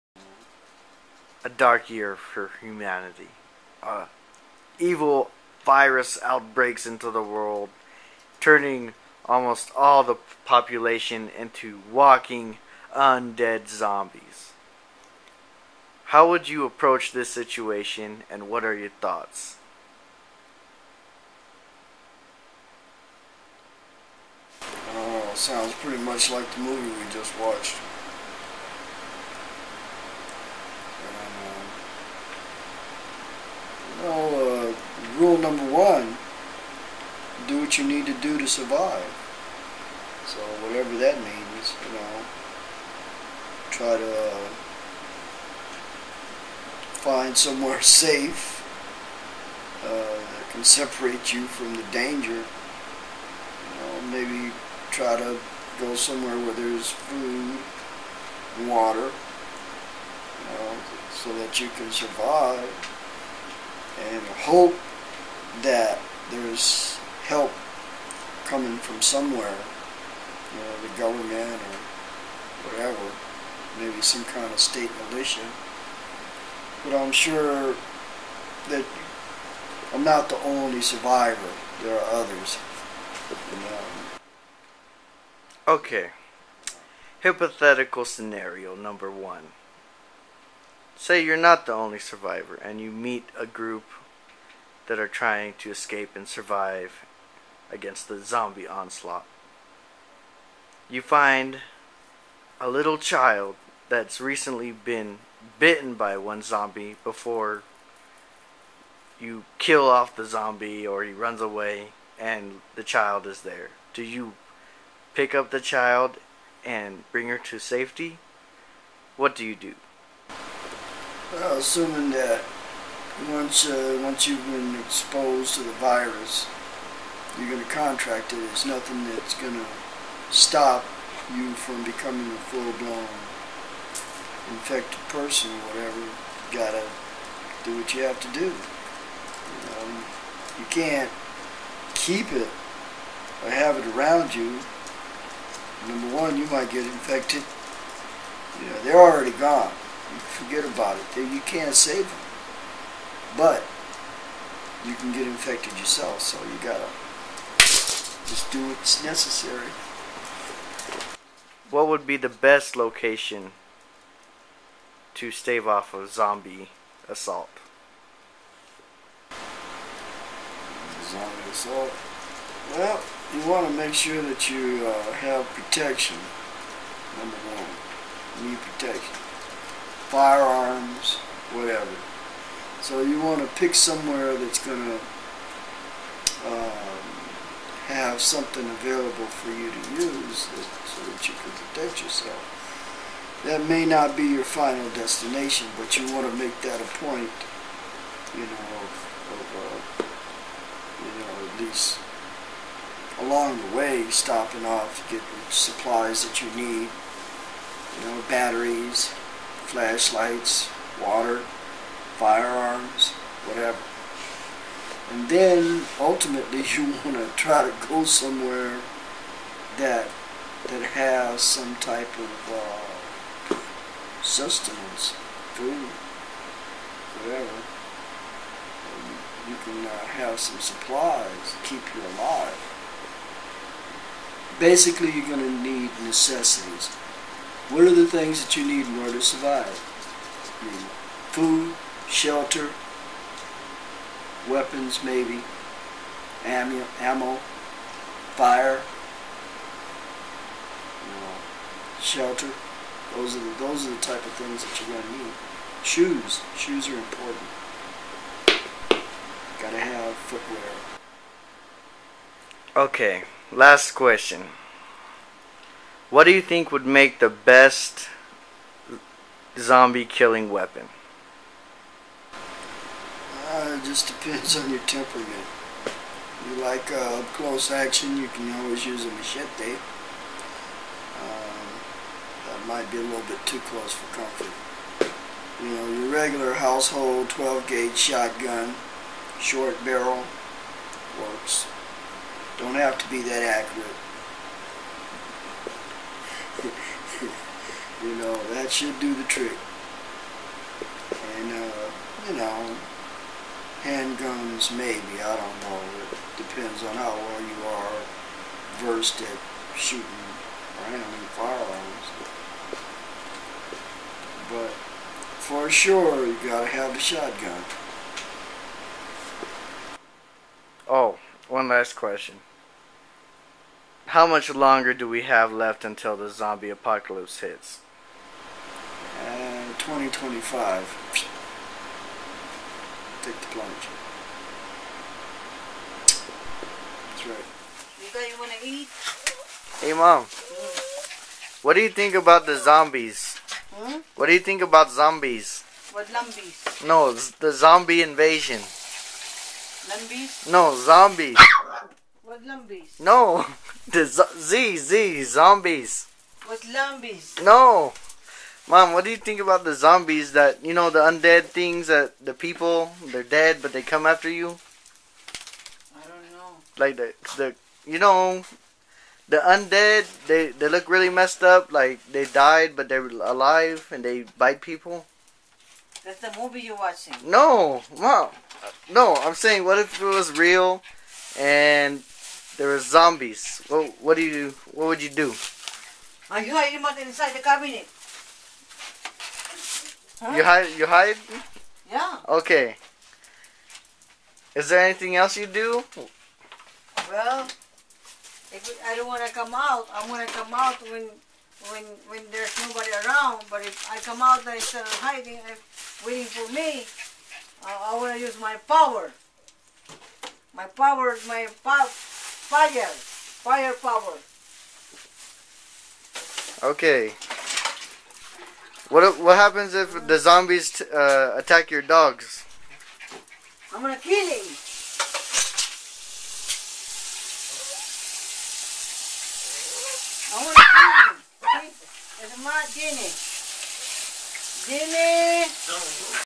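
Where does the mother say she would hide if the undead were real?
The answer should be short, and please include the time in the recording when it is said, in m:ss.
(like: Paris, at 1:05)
inside the cabinet, at 6:27.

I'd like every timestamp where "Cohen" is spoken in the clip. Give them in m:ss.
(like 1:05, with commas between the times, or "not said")
not said.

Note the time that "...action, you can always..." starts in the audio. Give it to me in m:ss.
4:37.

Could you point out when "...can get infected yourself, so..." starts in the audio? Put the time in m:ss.
2:34.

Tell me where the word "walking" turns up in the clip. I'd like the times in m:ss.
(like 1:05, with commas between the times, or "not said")
0:11.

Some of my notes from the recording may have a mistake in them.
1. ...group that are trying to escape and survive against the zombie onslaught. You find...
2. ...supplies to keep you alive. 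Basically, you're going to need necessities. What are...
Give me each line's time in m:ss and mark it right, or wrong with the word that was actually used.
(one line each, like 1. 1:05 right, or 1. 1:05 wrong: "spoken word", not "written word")
1. 1:33 right
2. 3:50 right.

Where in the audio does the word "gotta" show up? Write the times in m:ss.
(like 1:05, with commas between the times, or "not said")
2:16, 2:36, 4:19, 5:16.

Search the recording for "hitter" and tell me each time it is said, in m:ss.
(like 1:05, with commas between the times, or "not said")
not said.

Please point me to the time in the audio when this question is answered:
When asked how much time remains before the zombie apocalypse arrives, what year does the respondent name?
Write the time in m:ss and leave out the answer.
5:29.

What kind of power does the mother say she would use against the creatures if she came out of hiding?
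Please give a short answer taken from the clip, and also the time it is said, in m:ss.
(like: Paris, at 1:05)
firepower, at 6:53.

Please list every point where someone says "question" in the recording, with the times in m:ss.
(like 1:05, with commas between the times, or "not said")
4:23, 5:21.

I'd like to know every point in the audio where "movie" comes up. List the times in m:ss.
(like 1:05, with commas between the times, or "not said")
0:26, 6:16.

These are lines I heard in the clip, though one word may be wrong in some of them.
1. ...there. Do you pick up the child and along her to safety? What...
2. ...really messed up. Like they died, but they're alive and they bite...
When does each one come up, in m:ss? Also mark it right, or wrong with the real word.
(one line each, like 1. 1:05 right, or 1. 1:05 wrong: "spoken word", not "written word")
1. 1:53 wrong: "bring", not "along"
2. 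6:10 right.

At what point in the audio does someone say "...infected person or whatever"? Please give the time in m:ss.
2:14.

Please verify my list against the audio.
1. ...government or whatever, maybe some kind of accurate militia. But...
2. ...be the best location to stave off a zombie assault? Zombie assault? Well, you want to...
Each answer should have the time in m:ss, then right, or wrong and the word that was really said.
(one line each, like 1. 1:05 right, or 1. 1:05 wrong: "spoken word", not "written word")
1. 1:10 wrong: "state", not "accurate"
2. 2:42 right.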